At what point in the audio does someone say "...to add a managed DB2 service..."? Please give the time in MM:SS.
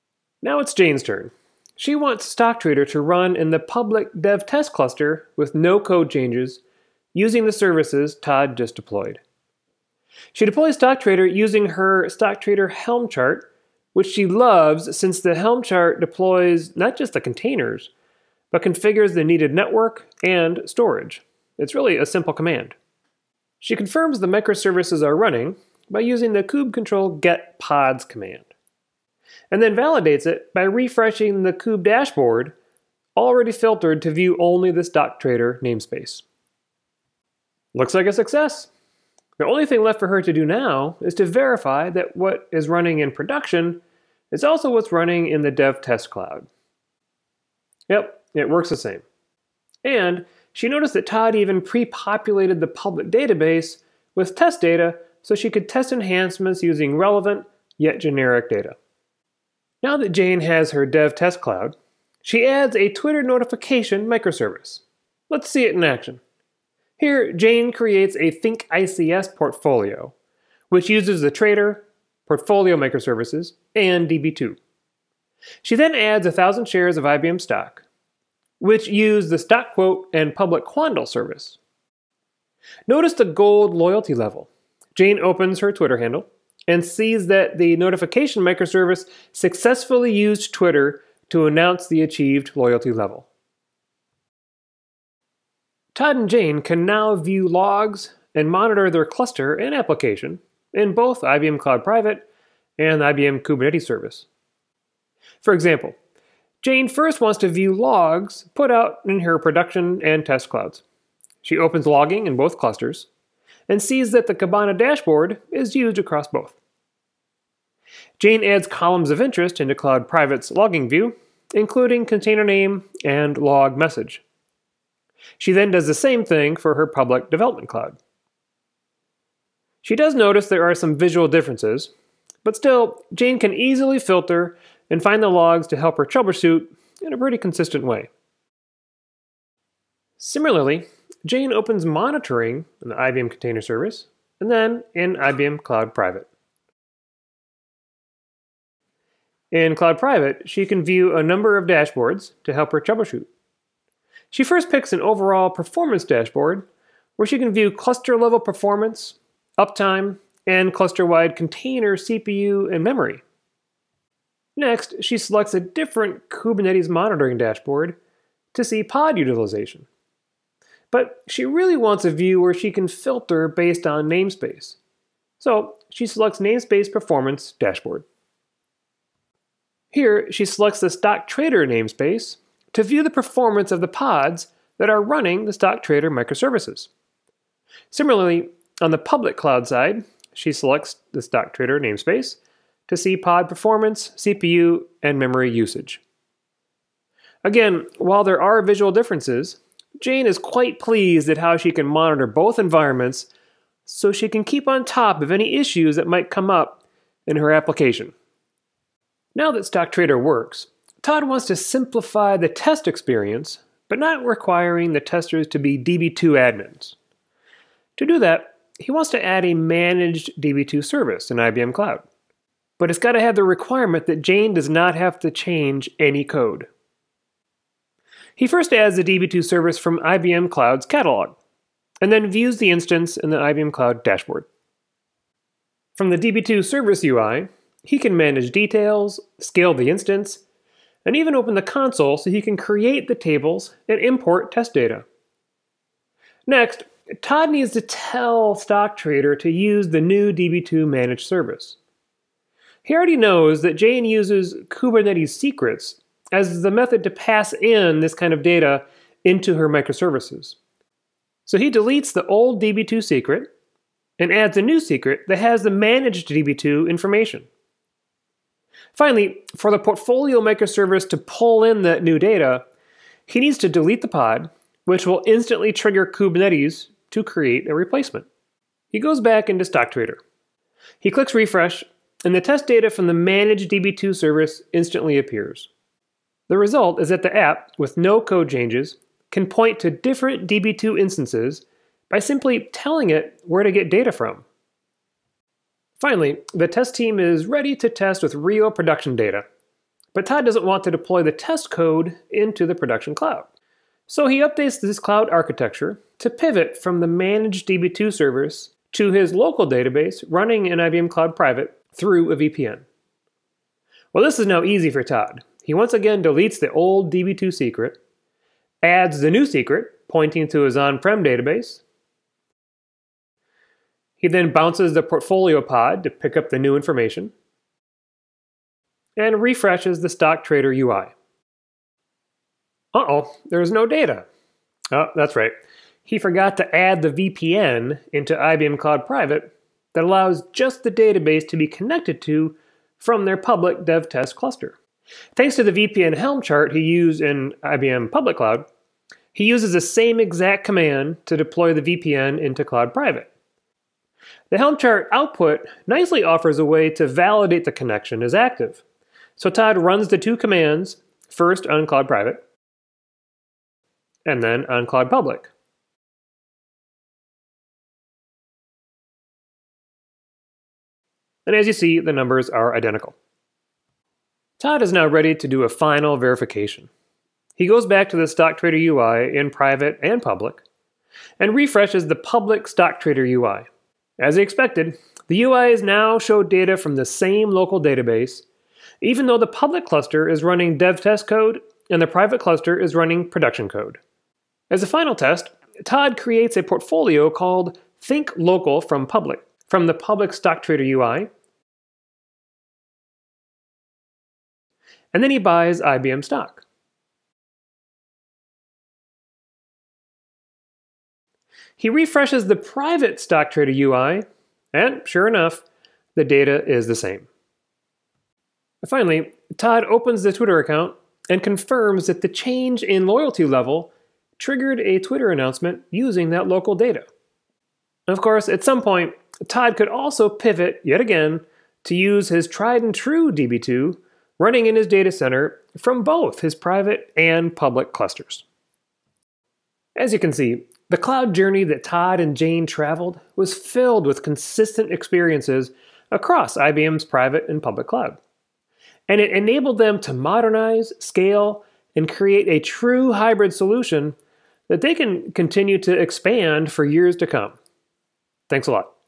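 03:39.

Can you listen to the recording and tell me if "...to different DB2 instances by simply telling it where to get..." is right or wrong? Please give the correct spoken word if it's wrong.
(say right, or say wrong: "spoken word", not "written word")
right.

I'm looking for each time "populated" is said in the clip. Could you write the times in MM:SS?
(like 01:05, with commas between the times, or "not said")
00:51.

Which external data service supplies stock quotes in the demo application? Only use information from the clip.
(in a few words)
quandl.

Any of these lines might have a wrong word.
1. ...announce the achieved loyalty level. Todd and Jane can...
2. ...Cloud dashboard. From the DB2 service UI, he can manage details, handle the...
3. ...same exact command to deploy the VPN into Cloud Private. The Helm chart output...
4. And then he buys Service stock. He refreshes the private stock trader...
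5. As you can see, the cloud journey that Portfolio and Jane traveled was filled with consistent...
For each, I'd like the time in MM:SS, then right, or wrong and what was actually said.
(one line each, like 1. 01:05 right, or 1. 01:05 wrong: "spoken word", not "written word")
1. 01:31 right
2. 03:53 wrong: "scale", not "handle"
3. 05:49 right
4. 06:45 wrong: "IBM", not "Service"
5. 07:19 wrong: "Todd", not "Portfolio".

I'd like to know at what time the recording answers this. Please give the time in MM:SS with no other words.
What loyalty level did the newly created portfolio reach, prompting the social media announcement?
01:23.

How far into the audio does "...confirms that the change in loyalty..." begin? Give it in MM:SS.
07:01.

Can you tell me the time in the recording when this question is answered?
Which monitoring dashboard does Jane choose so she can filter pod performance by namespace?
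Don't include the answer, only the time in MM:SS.
02:56.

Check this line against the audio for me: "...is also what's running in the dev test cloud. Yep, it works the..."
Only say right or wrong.
right.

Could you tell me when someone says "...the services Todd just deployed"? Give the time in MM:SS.
00:07.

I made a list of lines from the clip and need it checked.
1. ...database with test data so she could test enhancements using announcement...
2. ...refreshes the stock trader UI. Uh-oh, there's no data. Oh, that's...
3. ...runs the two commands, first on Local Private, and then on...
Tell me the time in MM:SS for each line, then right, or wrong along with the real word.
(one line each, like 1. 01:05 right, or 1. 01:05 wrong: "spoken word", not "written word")
1. 00:53 wrong: "relevant", not "announcement"
2. 05:29 right
3. 05:59 wrong: "Cloud", not "Local".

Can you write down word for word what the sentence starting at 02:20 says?
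Similarly, Jane opens monitoring in the IBM Container Service and then in IBM Cloud Private.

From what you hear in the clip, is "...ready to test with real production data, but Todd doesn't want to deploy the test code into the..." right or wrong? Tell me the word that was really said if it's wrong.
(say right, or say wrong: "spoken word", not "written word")
right.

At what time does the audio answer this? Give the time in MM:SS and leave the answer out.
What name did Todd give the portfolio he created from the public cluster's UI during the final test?
06:38.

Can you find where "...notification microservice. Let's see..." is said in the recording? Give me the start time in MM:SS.
01:03.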